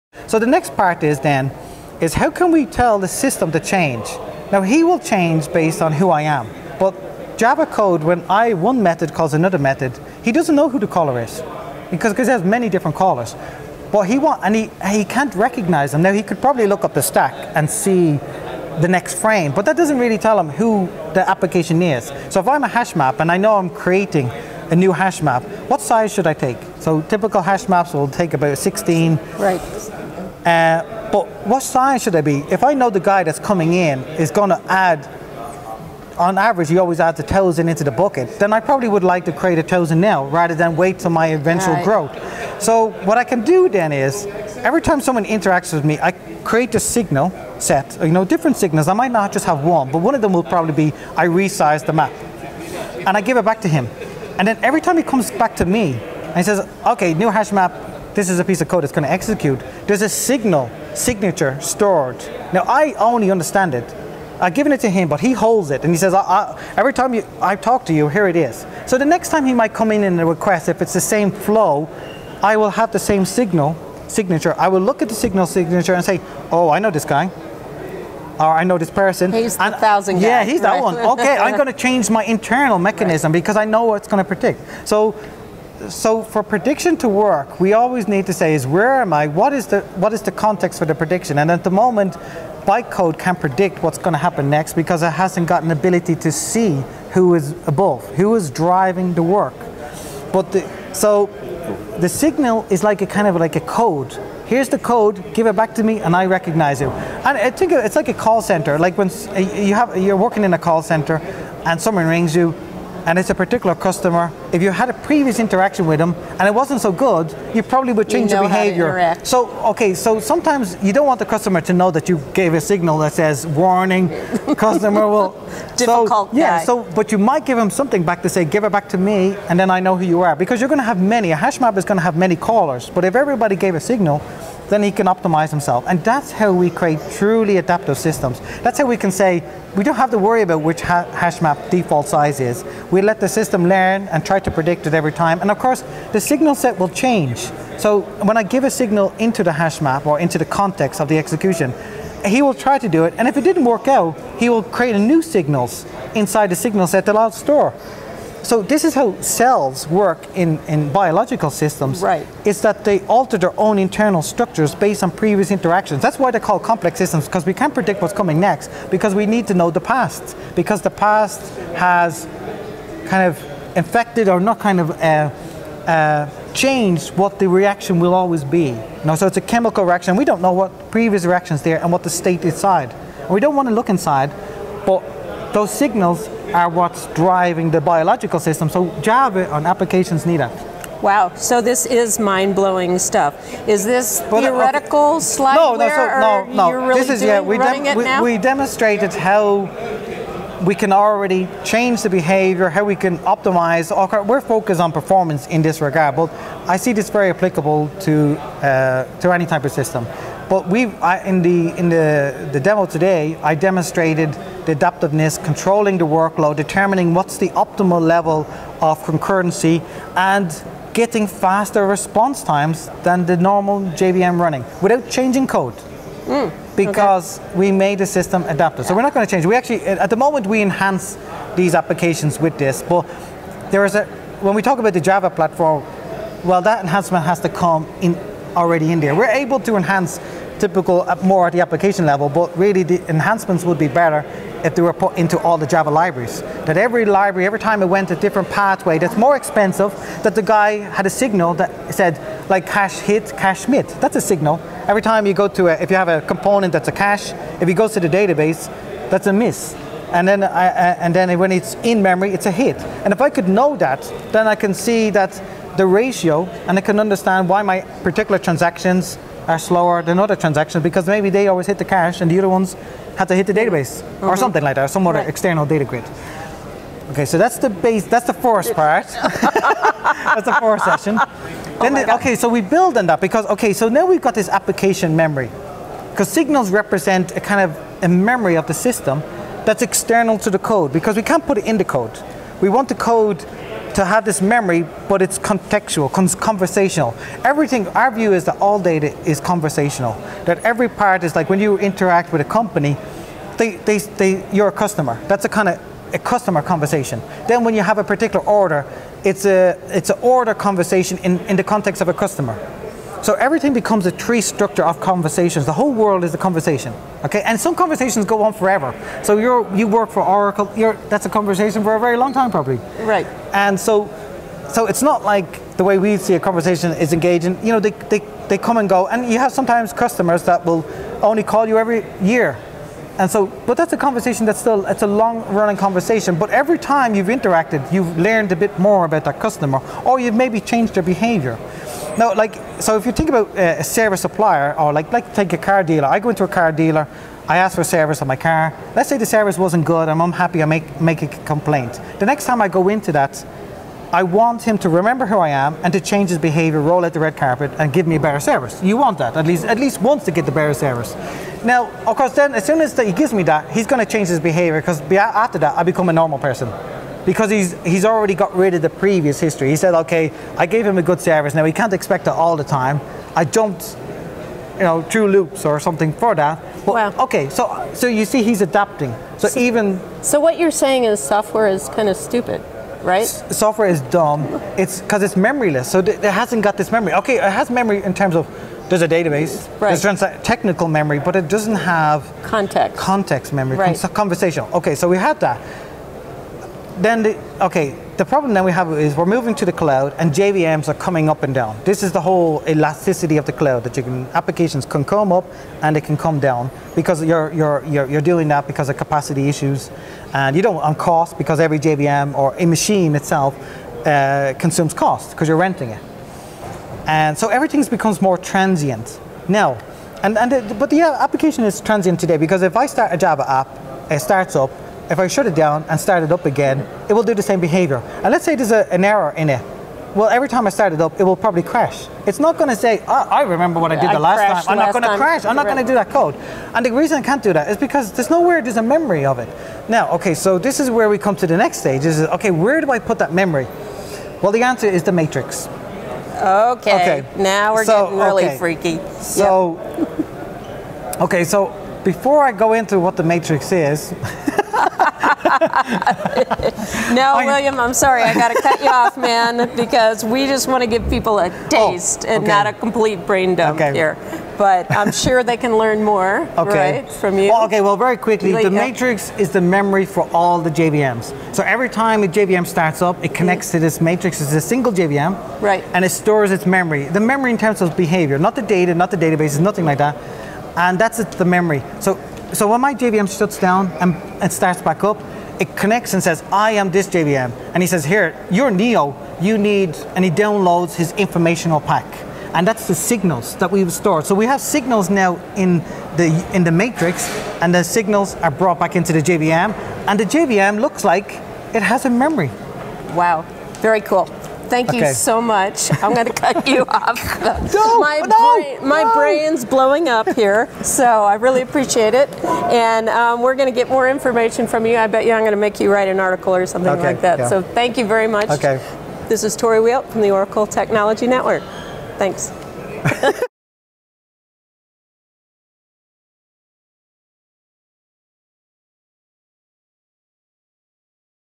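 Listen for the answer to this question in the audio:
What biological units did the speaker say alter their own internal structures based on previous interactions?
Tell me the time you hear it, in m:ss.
2:39.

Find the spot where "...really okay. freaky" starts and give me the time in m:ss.
7:28.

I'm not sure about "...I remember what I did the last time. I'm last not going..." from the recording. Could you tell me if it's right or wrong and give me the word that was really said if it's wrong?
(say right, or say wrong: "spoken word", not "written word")
right.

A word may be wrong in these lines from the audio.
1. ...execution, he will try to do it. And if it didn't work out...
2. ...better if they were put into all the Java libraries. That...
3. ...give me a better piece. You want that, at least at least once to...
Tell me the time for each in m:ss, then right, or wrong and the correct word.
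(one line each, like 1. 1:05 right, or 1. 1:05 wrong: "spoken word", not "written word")
1. 2:31 right
2. 4:03 right
3. 5:57 wrong: "service", not "piece".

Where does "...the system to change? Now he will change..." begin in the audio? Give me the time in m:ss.
0:02.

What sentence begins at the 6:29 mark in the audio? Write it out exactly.
there's technical memory, but it doesn't have context, context memory, right.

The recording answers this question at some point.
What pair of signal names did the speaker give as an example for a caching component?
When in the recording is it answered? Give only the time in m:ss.
4:12.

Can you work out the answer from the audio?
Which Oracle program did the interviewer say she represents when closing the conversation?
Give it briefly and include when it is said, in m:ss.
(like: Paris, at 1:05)
Oracle Technology Network, at 8:40.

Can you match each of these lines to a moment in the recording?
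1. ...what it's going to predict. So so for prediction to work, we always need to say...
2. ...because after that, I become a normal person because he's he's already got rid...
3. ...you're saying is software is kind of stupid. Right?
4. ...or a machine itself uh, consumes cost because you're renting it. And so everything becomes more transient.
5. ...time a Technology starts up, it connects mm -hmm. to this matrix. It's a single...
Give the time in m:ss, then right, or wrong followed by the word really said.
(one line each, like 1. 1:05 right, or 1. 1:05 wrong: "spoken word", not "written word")
1. 1:23 right
2. 6:04 right
3. 6:20 right
4. 6:52 right
5. 7:51 wrong: "JVM", not "Technology".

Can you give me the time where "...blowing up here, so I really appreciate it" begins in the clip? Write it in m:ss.
8:29.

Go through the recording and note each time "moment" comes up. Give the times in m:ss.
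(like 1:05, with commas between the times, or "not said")
1:31, 3:50.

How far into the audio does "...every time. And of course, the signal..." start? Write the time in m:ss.
2:24.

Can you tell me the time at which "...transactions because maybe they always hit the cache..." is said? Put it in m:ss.
4:30.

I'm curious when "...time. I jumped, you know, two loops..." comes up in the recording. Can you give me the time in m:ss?
6:12.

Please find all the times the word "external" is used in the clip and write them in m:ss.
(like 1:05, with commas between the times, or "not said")
4:35, 4:49.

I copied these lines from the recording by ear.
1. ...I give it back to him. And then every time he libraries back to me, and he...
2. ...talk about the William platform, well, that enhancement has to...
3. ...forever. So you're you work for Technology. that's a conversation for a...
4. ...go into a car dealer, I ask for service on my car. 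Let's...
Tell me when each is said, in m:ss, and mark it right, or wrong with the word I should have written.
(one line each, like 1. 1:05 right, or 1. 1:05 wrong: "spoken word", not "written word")
1. 0:53 wrong: "comes", not "libraries"
2. 3:54 wrong: "Java", not "William"
3. 5:18 wrong: "Oracle", not "Technology"
4. 5:46 right.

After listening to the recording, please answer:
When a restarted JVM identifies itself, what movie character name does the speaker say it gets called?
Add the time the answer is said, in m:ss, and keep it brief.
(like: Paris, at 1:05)
Neo, at 8:08.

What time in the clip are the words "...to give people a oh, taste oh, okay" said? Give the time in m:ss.
7:40.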